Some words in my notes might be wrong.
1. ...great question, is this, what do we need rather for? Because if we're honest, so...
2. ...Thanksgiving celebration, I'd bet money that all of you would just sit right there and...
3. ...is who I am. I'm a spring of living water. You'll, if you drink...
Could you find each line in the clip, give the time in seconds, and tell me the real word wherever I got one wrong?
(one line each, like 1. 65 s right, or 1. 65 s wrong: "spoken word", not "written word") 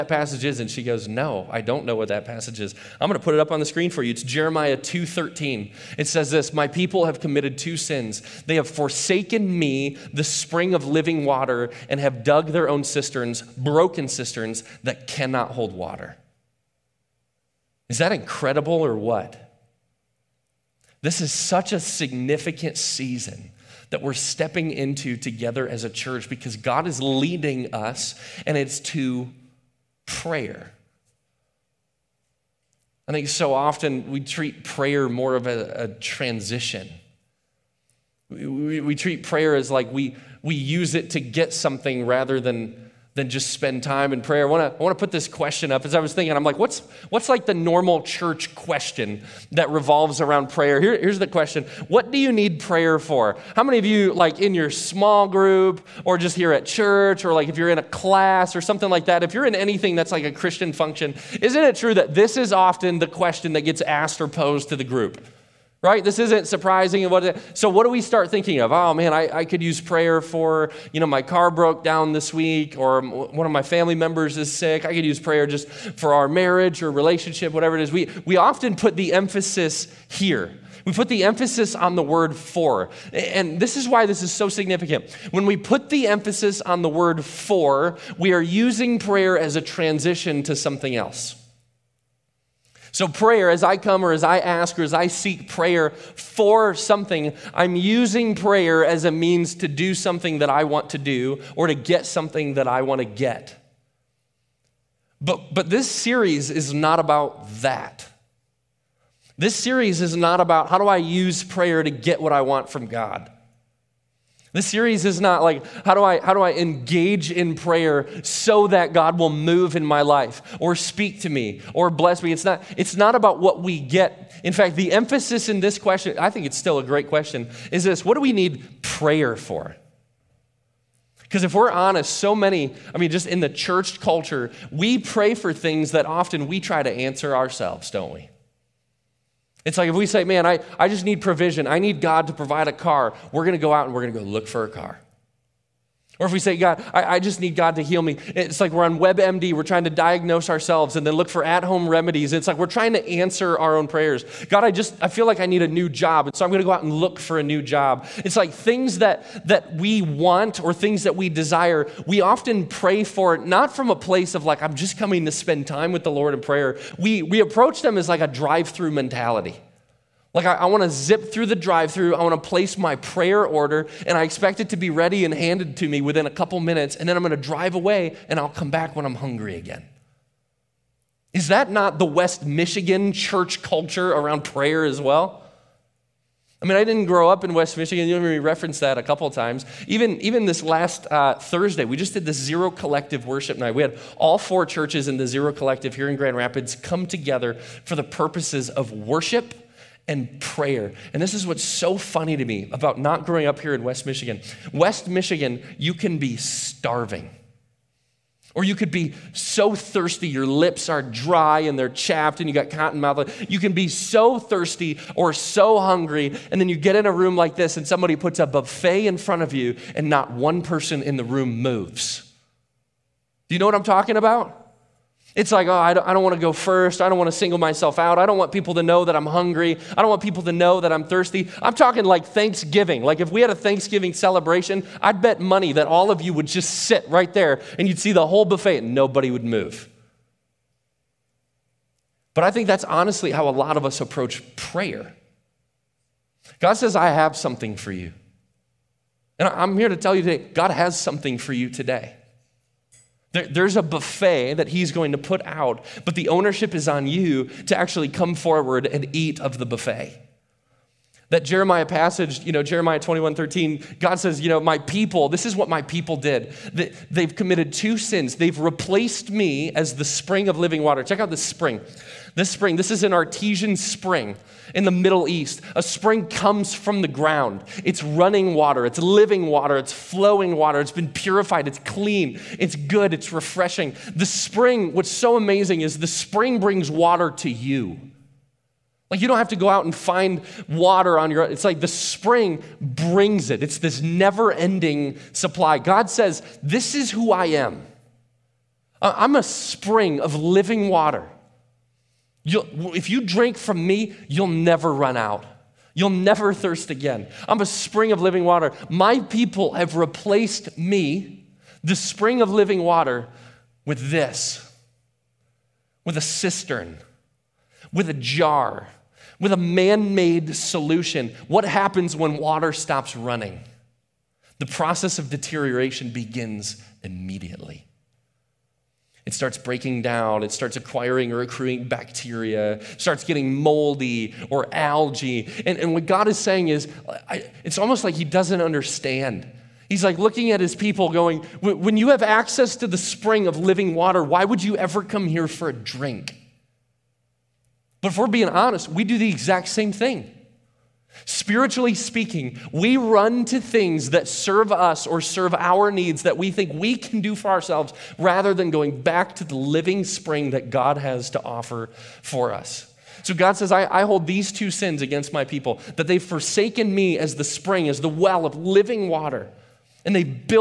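1. 126 s wrong: "prayer", not "rather"
2. 233 s right
3. 296 s right.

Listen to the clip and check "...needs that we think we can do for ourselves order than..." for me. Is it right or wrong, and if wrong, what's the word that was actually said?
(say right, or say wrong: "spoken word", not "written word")
wrong: "rather", not "order".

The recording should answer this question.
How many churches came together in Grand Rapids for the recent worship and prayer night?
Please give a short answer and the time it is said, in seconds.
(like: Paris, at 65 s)
4, at 194 s.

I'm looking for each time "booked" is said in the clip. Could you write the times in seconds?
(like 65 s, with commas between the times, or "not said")
not said.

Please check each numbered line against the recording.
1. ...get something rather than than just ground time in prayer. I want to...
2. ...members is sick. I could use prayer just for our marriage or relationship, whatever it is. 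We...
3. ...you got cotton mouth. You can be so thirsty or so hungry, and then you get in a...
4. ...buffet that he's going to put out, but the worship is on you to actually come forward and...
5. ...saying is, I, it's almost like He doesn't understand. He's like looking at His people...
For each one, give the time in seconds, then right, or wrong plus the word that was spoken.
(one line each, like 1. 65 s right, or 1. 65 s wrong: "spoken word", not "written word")
1. 41 s wrong: "spend", not "ground"
2. 73 s right
3. 212 s right
4. 253 s wrong: "ownership", not "worship"
5. 336 s right.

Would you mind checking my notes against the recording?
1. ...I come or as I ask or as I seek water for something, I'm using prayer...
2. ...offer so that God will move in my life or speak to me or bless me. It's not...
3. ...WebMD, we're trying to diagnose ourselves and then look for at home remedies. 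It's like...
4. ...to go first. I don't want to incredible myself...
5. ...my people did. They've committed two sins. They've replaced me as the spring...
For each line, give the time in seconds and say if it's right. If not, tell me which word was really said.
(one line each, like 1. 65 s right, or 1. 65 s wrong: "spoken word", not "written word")
1. 93 s wrong: "prayer", not "water"
2. 117 s wrong: "prayer", not "offer"
3. 148 s right
4. 226 s wrong: "single", not "incredible"
5. 265 s right.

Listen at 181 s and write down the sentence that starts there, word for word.
Is that not the West Michigan church culture around prayer as well?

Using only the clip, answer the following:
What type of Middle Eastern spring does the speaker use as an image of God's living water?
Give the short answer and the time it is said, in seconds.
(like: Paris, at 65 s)
Artesian spring, at 273 s.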